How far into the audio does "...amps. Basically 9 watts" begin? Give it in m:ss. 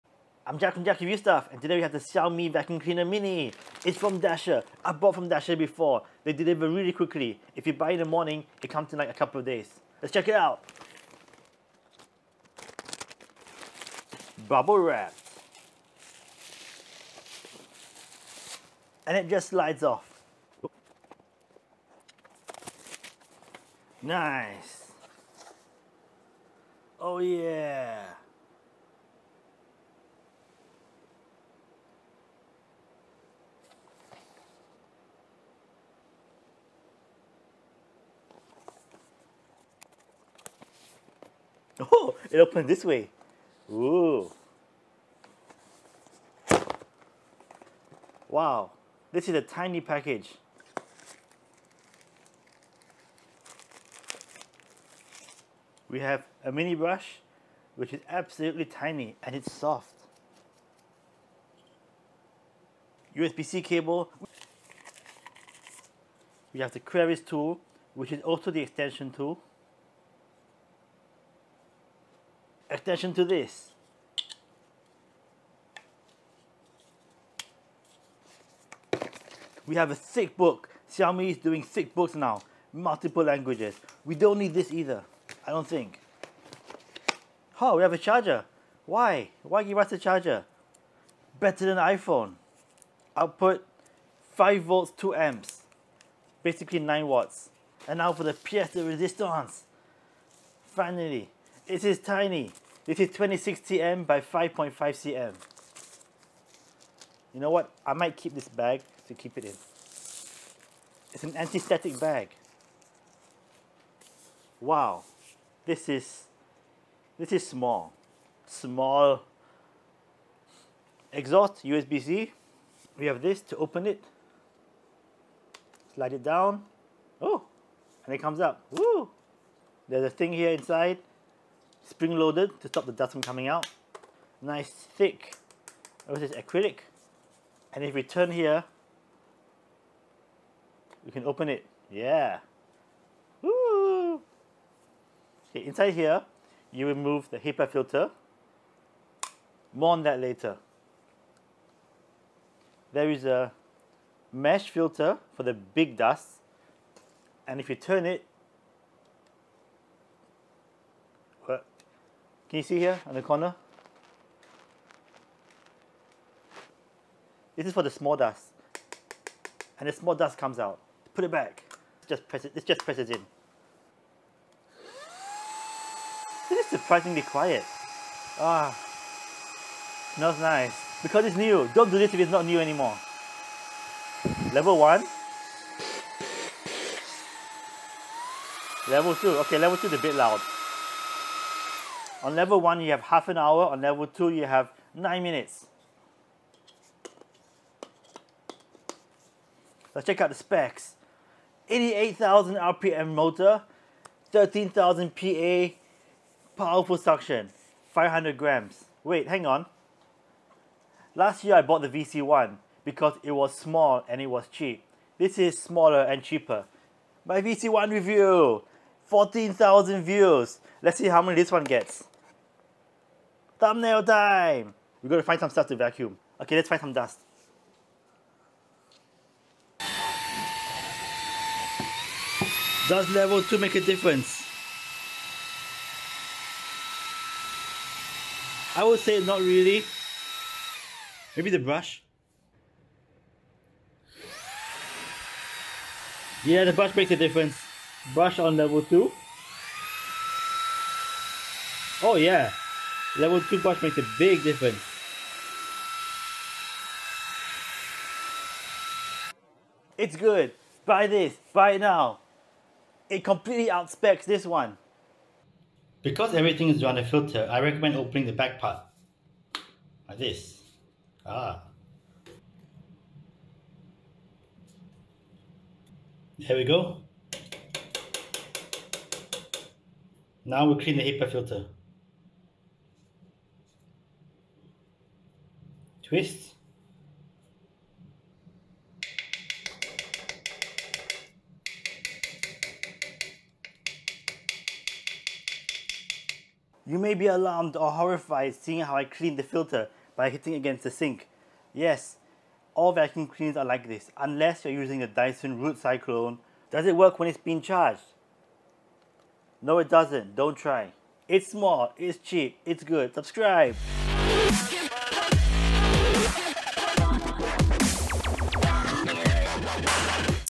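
1:35.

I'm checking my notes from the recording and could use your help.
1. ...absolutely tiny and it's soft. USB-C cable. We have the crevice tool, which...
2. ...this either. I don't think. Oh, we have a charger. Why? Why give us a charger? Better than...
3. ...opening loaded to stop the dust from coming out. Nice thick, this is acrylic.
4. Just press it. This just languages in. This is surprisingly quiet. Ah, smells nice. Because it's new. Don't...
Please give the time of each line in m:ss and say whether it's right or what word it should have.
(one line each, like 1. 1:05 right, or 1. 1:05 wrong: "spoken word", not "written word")
1. 0:58 right
2. 1:24 right
3. 2:11 wrong: "spring", not "opening"
4. 2:52 wrong: "presses", not "languages".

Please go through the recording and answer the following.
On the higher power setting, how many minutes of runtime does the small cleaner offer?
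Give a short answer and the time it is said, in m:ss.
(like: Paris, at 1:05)
9 minutes, at 3:14.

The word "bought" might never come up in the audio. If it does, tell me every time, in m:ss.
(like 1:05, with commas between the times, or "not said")
0:04, 3:31.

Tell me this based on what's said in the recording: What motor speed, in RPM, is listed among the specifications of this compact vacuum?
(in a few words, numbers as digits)
88,000.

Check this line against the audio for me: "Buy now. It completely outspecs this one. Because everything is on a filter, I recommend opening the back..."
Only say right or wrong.
right.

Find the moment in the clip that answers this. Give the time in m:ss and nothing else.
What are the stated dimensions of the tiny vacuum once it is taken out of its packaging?
1:43.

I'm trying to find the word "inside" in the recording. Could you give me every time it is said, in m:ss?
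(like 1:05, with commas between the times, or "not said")
2:10, 2:25.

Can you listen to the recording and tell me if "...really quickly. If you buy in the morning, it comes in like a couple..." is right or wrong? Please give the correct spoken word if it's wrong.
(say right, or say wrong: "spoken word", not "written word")
right.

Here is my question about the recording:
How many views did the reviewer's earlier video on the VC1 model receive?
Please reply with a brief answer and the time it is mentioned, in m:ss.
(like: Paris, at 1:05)
14,000, at 3:39.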